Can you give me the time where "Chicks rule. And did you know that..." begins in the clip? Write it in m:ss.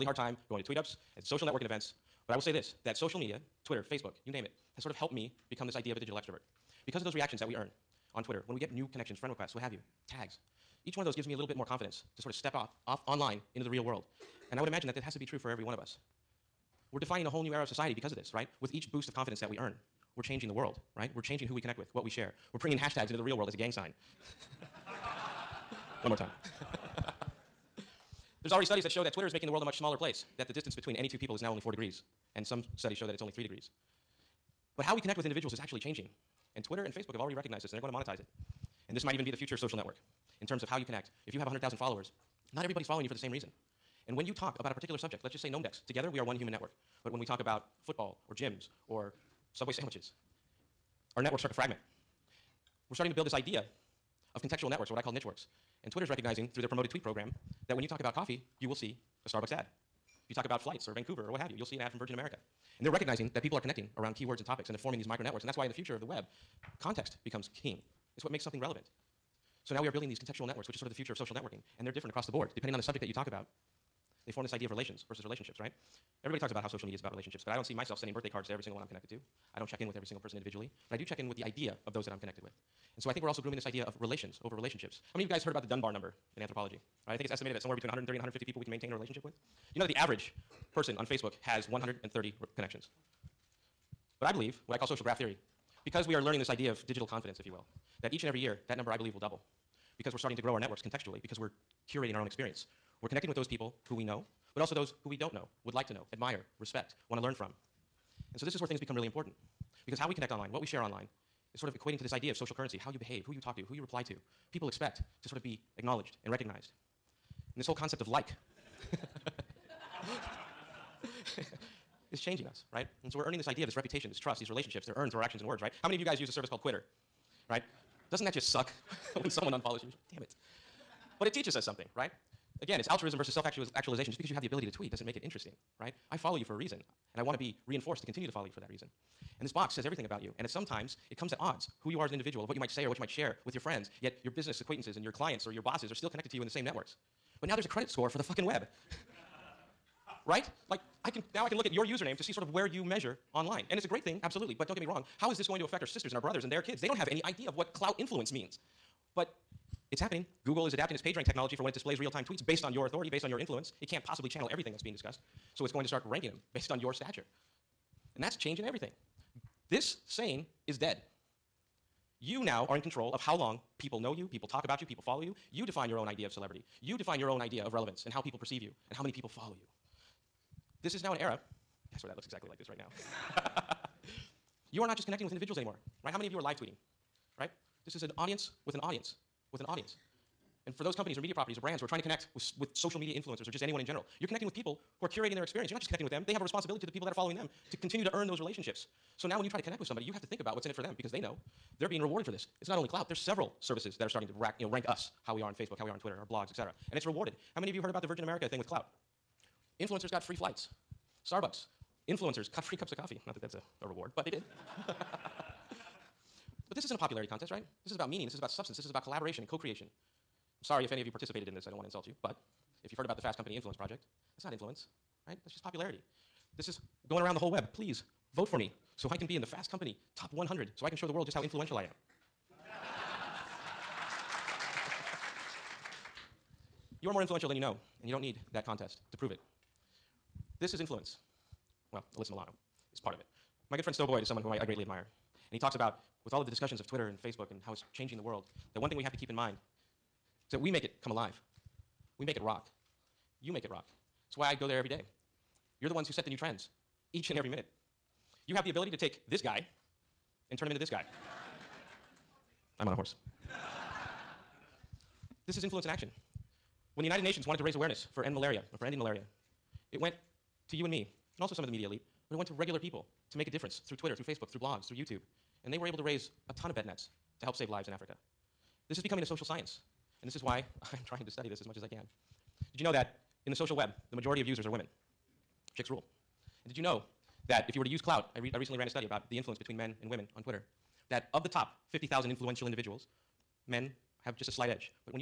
4:45.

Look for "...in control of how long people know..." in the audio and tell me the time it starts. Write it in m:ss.
2:52.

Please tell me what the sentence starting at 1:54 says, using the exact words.
People expect to sort of be acknowledged and recognized.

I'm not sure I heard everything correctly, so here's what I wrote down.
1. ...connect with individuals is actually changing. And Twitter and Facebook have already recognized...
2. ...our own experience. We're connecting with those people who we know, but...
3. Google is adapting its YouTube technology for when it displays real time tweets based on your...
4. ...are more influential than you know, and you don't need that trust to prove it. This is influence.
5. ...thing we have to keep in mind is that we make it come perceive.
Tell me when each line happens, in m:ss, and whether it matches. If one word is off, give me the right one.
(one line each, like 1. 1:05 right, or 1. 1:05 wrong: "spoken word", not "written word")
1. 0:35 right
2. 1:42 right
3. 2:40 wrong: "PageRank", not "YouTube"
4. 3:57 wrong: "contest", not "trust"
5. 4:08 wrong: "alive", not "perceive".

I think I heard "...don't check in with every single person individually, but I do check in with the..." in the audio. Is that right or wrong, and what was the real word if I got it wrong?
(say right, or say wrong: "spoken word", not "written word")
right.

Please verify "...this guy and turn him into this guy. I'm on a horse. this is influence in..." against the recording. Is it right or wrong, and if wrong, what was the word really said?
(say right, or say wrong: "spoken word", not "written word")
right.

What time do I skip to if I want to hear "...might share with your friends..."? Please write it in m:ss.
2:23.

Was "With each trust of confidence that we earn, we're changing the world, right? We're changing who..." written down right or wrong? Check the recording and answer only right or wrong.
wrong.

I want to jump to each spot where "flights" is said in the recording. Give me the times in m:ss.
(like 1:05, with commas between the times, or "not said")
1:00, 3:30.